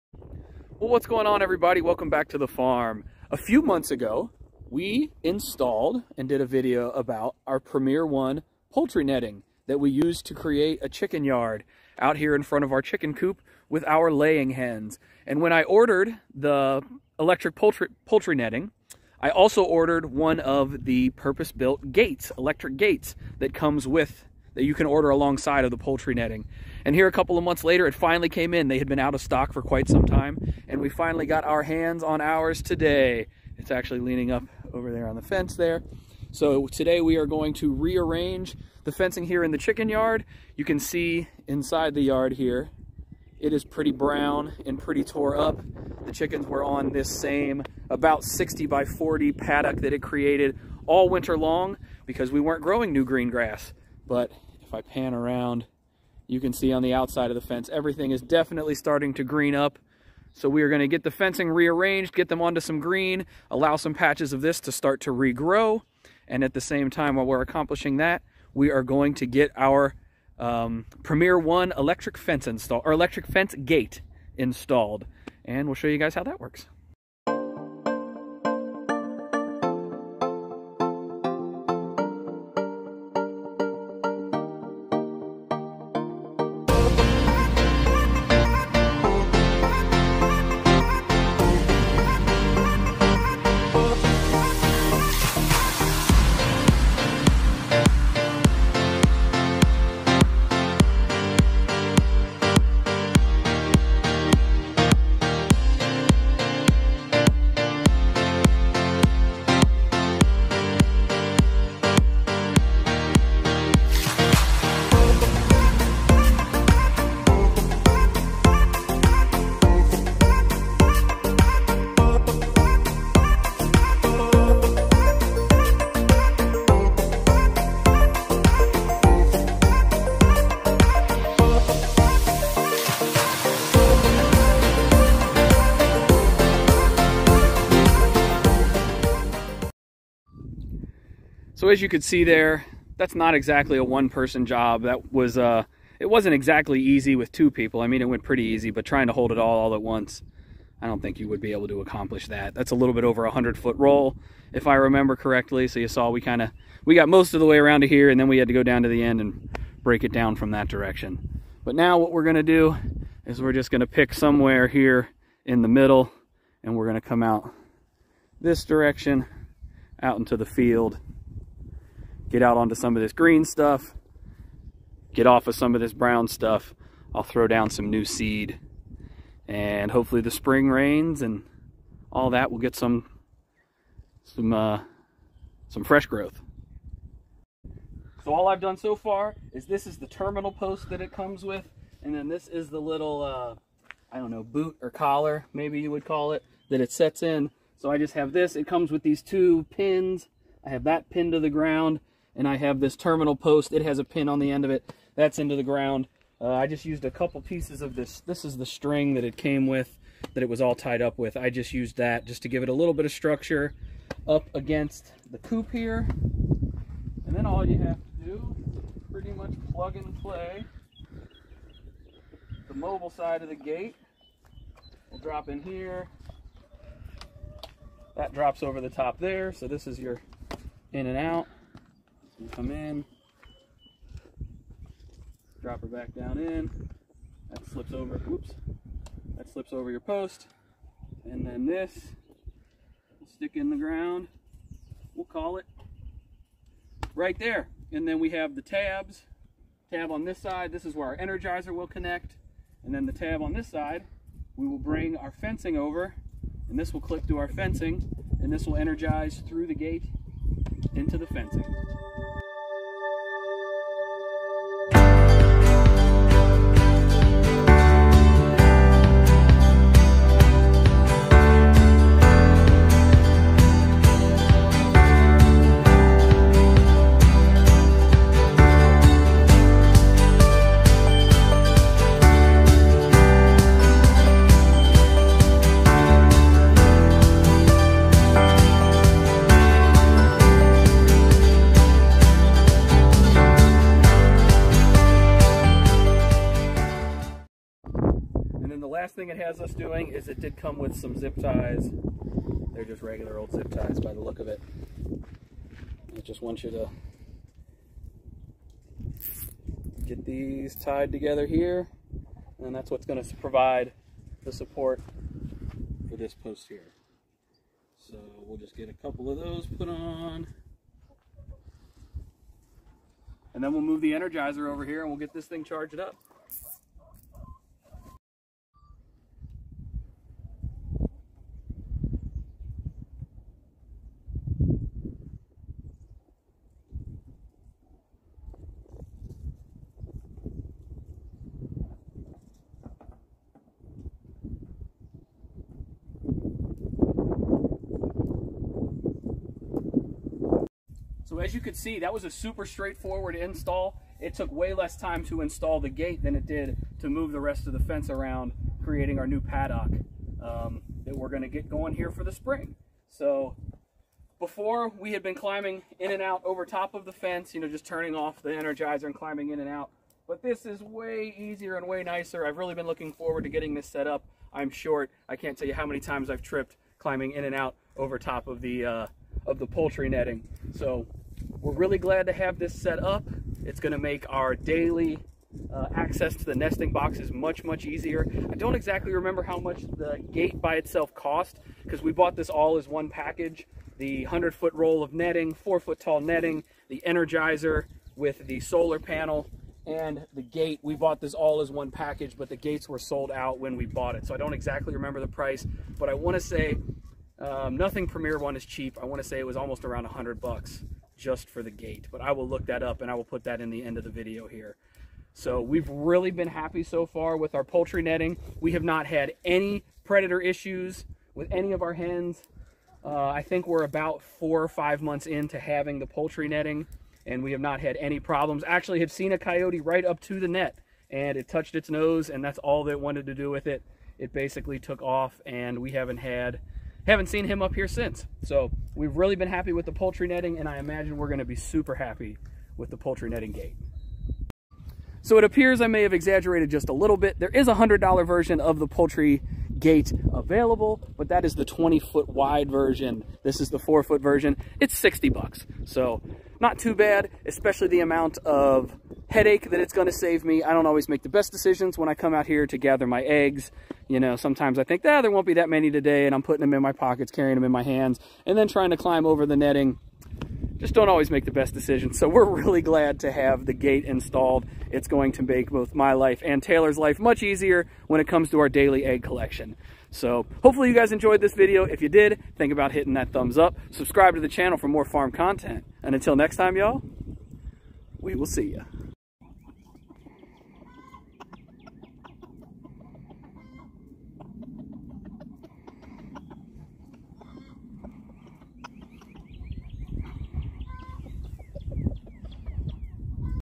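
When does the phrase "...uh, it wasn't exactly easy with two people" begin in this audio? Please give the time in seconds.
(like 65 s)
145 s.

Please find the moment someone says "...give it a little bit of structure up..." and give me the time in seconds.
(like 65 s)
212 s.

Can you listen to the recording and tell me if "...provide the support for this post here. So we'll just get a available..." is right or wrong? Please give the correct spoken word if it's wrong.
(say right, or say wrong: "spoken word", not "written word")
wrong: "couple", not "available".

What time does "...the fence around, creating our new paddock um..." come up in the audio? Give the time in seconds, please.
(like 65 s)
357 s.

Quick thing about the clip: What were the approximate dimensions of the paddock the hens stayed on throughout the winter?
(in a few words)
60 by 40.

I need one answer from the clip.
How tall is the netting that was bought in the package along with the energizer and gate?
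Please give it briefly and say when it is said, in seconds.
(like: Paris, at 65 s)
4 feet, at 395 s.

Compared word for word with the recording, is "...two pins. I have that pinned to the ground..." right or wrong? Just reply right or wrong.
right.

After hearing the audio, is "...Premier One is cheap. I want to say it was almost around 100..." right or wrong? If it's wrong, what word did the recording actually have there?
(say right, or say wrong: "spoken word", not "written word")
right.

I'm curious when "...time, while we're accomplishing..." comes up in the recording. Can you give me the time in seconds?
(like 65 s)
66 s.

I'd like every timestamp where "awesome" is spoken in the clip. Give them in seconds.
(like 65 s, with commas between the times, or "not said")
not said.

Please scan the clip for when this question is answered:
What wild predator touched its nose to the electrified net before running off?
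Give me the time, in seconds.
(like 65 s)
429 s.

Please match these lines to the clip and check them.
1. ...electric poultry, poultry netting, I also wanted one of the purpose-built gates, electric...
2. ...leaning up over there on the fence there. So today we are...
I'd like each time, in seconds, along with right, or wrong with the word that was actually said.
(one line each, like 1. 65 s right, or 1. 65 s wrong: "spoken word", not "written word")
1. 17 s wrong: "ordered", not "wanted"
2. 33 s right.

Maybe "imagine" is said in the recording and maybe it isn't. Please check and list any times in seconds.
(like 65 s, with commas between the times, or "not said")
440 s.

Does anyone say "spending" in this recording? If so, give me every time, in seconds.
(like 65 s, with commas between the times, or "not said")
not said.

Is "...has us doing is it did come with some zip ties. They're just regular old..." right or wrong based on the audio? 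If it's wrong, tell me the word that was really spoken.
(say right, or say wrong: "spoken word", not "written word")
right.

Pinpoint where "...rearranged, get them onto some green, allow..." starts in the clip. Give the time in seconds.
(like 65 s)
61 s.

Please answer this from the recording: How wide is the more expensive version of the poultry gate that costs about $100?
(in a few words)
20 feet.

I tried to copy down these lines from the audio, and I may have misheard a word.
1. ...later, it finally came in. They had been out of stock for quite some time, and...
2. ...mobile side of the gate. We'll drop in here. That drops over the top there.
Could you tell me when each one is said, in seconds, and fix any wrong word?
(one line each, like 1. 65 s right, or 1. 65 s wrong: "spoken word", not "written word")
1. 27 s right
2. 222 s right.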